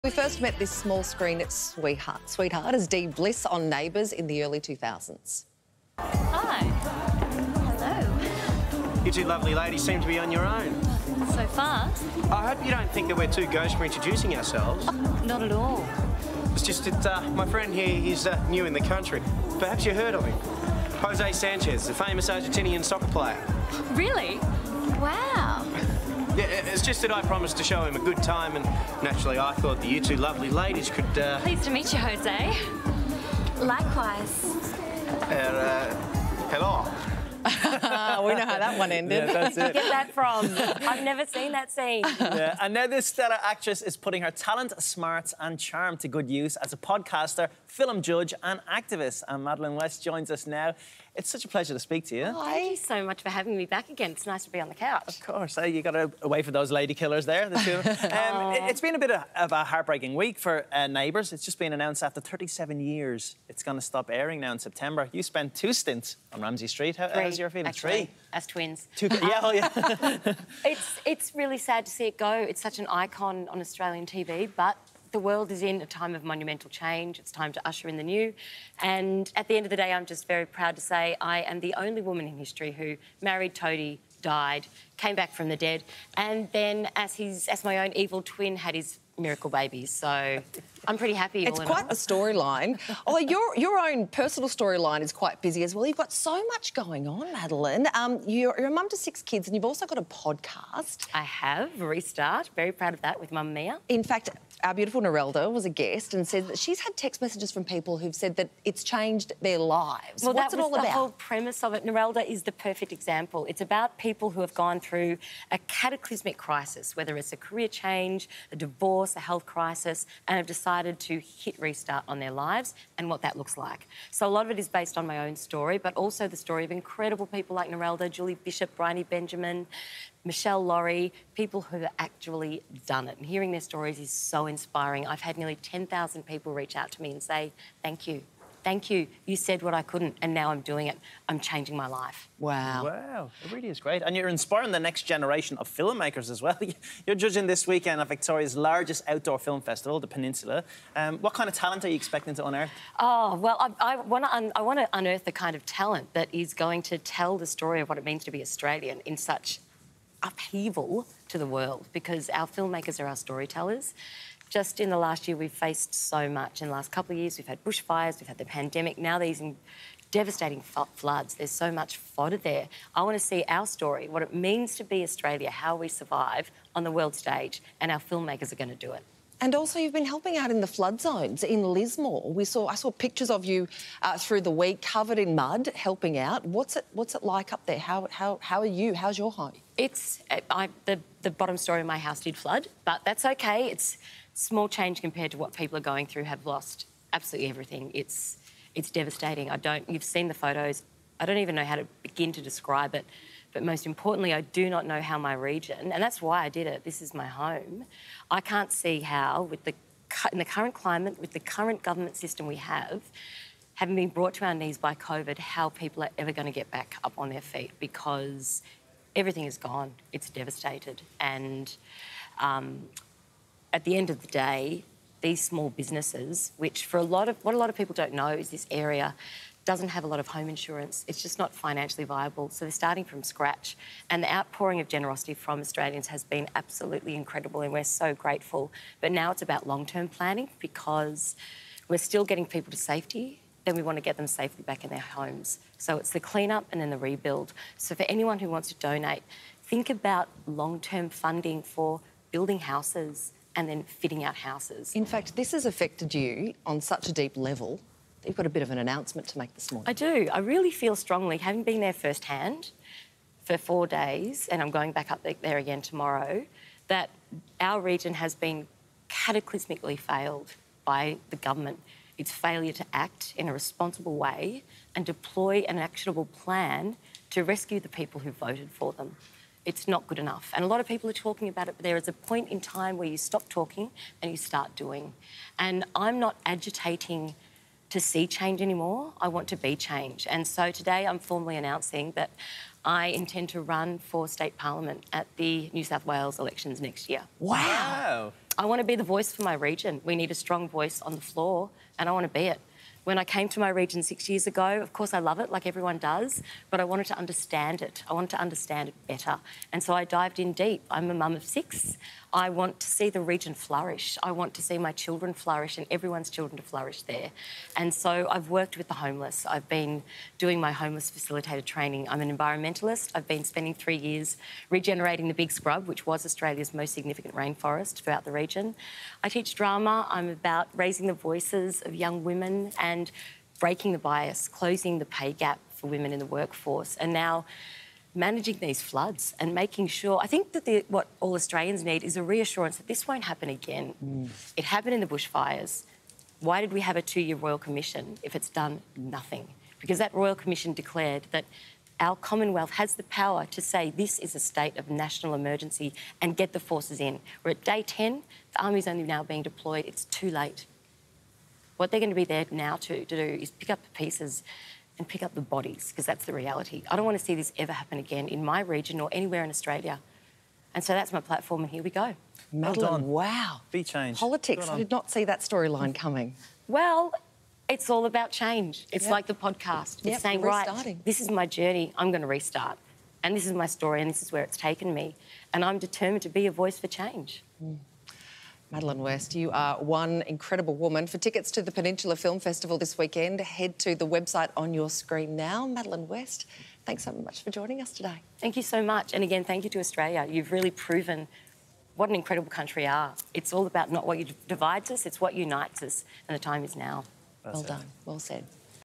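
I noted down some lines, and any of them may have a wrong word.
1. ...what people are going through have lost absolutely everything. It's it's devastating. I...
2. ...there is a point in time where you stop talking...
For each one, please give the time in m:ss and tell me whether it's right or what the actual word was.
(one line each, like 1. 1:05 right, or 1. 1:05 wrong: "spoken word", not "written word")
1. 3:15 right
2. 4:41 right.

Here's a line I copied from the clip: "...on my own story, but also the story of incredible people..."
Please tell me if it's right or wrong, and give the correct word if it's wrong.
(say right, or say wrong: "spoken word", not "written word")
right.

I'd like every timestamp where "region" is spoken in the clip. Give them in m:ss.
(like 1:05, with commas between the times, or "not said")
3:25, 4:27, 4:59, 5:03, 5:13, 5:28, 6:08.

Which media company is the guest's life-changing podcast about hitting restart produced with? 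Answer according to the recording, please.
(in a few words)
Mamamia.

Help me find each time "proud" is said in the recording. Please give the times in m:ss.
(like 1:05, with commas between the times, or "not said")
1:20, 1:42.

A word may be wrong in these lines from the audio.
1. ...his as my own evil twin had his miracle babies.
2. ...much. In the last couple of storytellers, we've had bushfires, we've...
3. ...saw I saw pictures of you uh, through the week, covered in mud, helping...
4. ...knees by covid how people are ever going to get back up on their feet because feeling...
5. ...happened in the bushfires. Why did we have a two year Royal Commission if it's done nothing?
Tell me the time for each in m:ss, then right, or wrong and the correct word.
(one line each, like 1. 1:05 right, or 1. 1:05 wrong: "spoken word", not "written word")
1. 1:27 right
2. 2:46 wrong: "years", not "storytellers"
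3. 3:02 right
4. 3:34 wrong: "everything", not "feeling"
5. 5:44 right.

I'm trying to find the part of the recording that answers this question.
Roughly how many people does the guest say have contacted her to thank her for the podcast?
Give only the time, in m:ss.
2:15.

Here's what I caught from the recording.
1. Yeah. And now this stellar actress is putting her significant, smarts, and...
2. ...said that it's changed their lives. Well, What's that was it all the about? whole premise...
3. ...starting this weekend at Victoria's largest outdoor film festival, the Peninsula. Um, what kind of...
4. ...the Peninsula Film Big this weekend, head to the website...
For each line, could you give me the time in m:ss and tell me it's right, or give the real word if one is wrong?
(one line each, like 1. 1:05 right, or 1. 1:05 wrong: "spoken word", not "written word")
1. 0:42 wrong: "talent", not "significant"
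2. 1:48 right
3. 2:27 wrong: "judging", not "starting"
4. 6:31 wrong: "Festival", not "Big".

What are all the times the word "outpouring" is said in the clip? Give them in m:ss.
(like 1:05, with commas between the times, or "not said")
3:54.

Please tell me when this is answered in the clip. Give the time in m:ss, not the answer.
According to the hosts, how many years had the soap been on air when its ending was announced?
1:02.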